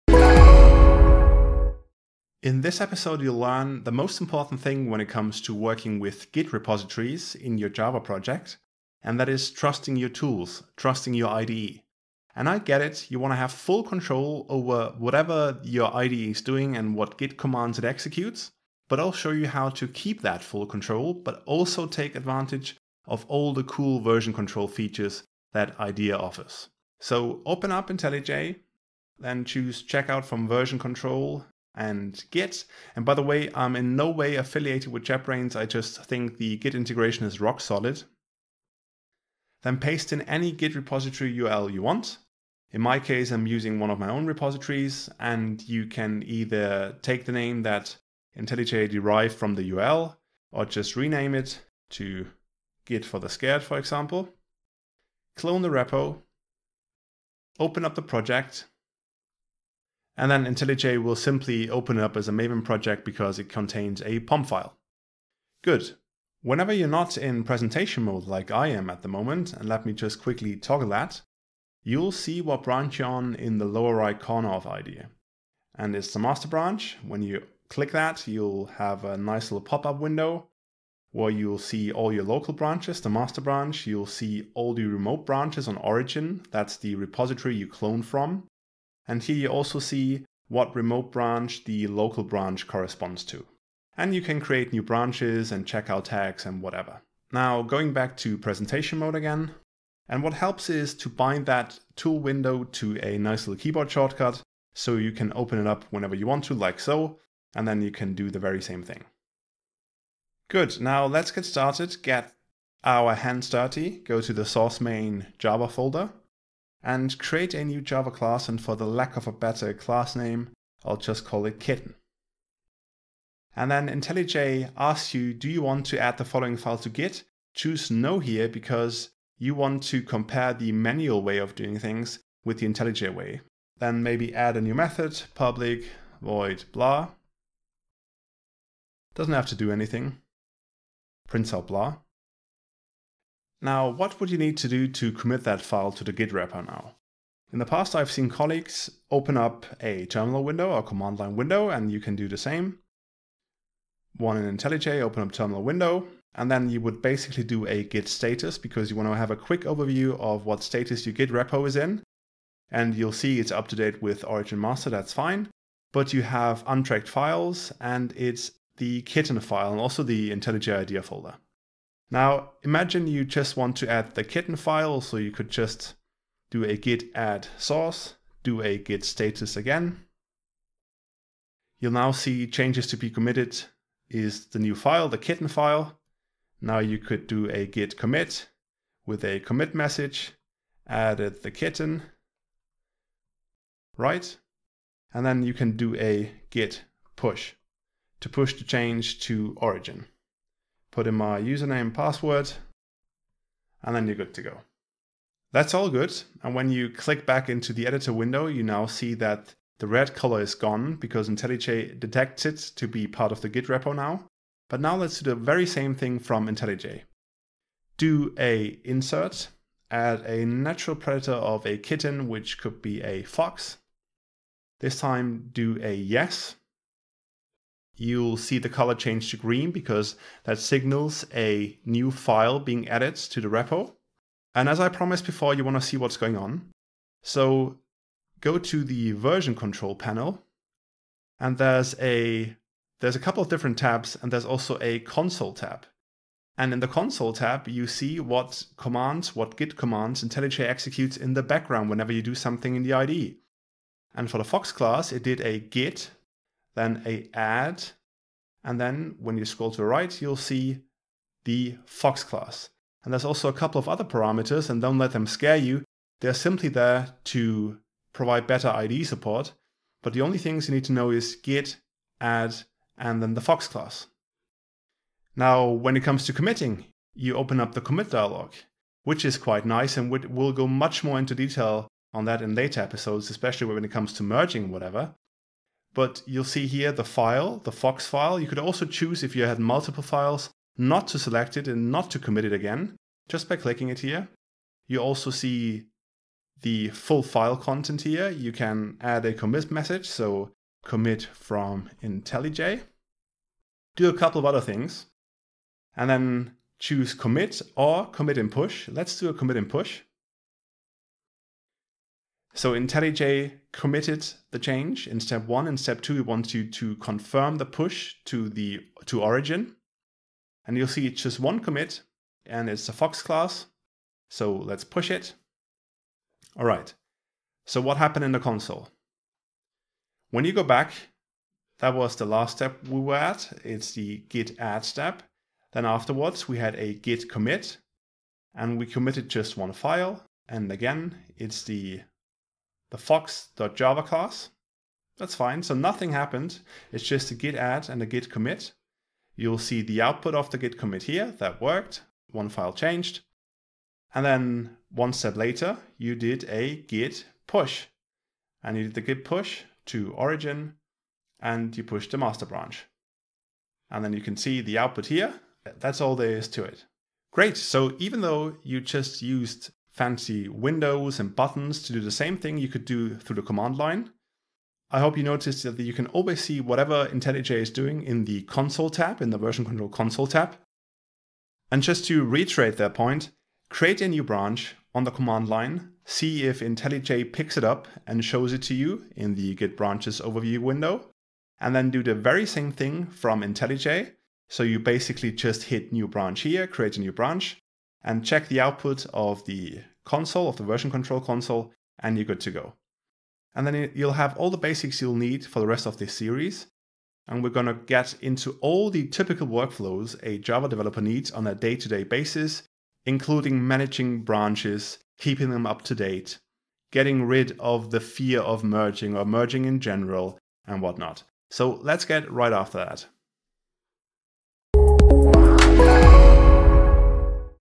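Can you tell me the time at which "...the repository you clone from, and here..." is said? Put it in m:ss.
1:26.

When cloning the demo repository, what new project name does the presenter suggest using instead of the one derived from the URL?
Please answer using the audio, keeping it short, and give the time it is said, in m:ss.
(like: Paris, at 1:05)
Git for the Scared, at 0:52.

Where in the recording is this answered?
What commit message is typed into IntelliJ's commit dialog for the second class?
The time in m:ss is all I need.
5:00.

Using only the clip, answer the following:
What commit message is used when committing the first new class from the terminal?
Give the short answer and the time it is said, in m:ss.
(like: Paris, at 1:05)
added the kitten, at 3:10.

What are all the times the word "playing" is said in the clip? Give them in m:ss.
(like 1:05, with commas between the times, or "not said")
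not said.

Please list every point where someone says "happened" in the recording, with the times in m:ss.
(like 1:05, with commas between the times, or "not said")
5:27, 5:46.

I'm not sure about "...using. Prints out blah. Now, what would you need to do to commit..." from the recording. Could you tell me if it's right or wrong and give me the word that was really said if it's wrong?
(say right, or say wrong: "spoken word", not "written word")
wrong: "anything", not "using".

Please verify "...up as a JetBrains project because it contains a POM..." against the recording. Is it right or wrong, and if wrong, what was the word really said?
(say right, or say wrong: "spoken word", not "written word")
wrong: "Maven", not "JetBrains".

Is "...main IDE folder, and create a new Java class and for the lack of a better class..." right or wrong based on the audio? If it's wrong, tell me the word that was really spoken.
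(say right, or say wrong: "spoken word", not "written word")
wrong: "Java", not "IDE".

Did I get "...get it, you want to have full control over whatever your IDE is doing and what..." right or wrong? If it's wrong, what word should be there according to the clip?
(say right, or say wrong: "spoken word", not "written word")
right.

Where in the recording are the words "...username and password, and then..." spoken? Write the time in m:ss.
3:21.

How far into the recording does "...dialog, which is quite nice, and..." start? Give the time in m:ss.
4:38.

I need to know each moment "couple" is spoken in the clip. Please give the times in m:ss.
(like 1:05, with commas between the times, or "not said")
4:03, 4:23, 5:04.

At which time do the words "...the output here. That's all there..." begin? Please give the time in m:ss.
6:04.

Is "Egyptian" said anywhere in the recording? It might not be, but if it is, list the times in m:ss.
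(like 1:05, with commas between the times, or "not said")
not said.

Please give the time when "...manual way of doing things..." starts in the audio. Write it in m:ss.
2:10.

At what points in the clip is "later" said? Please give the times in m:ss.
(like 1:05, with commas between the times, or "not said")
4:42, 5:55.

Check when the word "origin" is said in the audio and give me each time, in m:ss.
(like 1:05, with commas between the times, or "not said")
1:25, 2:44, 3:19, 5:19, 6:00.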